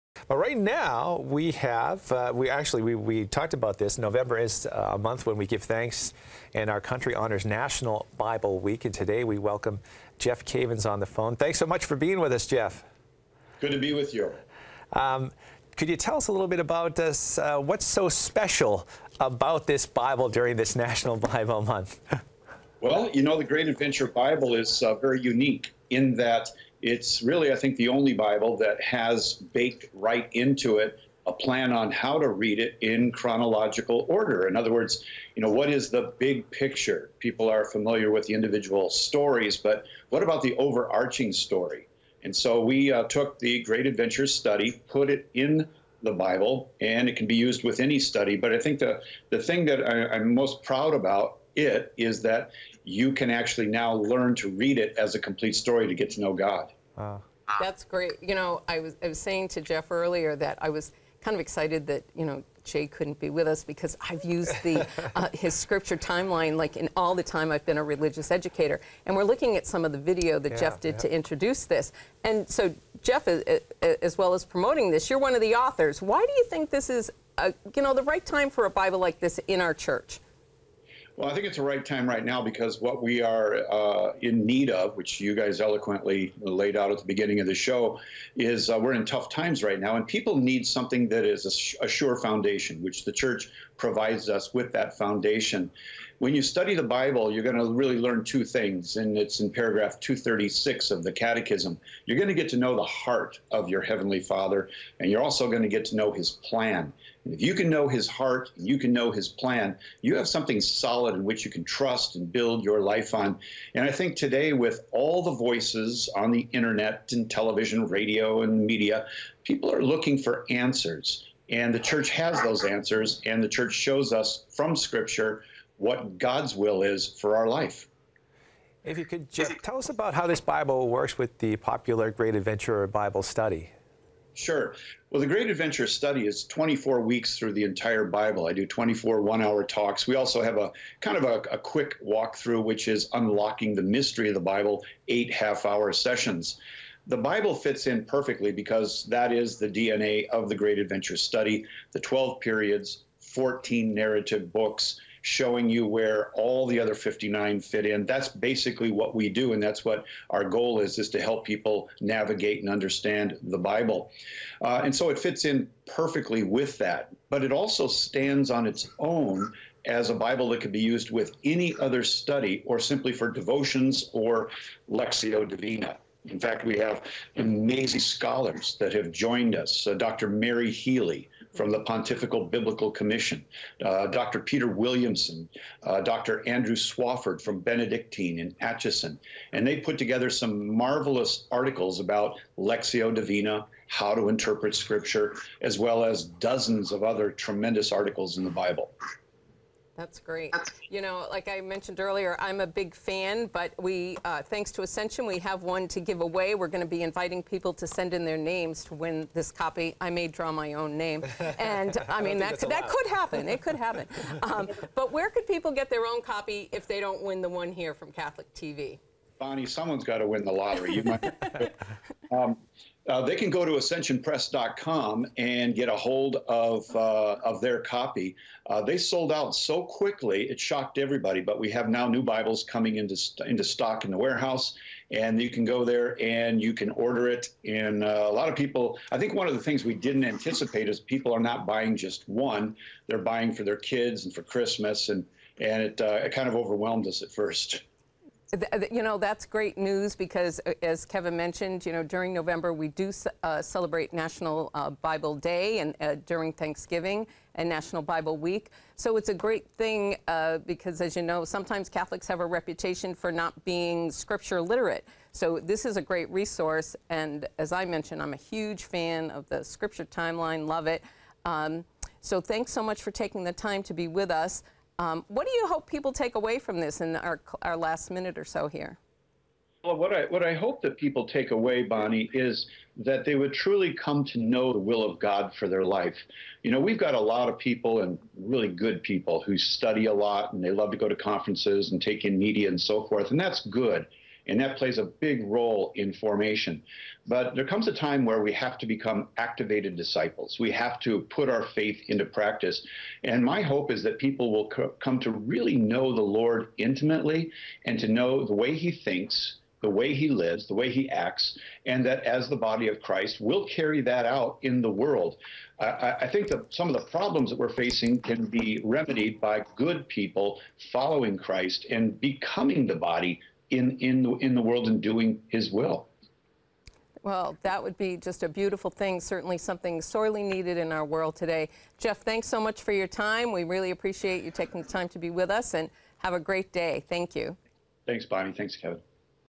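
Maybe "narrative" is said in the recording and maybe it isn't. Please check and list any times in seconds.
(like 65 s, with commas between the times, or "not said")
153 s.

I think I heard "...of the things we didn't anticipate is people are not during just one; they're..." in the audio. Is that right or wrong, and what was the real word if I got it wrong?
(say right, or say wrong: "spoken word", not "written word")
wrong: "buying", not "during".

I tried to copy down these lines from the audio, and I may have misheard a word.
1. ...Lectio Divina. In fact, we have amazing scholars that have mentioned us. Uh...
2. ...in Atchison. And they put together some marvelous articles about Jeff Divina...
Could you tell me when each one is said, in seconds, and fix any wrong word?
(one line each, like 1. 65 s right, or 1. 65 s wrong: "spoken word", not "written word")
1. 174 s wrong: "joined", not "mentioned"
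2. 188 s wrong: "Lectio", not "Jeff".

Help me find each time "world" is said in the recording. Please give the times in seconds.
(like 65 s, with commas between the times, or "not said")
314 s, 324 s, 331 s.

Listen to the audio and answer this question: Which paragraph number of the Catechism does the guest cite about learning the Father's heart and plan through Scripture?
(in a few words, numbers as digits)
236.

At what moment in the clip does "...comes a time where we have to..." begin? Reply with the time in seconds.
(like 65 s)
297 s.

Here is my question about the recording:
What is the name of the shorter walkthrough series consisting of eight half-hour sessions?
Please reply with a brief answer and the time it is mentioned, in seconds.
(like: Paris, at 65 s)
Unlocking the Mystery of the Bible, at 143 s.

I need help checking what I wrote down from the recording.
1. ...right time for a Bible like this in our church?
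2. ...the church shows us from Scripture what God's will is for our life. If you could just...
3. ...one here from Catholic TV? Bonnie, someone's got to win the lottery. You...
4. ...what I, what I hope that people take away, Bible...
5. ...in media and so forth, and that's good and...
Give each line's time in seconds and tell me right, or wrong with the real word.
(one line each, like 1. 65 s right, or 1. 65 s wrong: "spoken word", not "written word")
1. 78 s right
2. 123 s right
3. 217 s right
4. 279 s wrong: "Bonnie", not "Bible"
5. 292 s right.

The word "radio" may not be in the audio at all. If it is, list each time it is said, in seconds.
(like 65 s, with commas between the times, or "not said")
117 s.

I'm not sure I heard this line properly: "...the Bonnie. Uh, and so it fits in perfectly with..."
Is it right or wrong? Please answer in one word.
wrong.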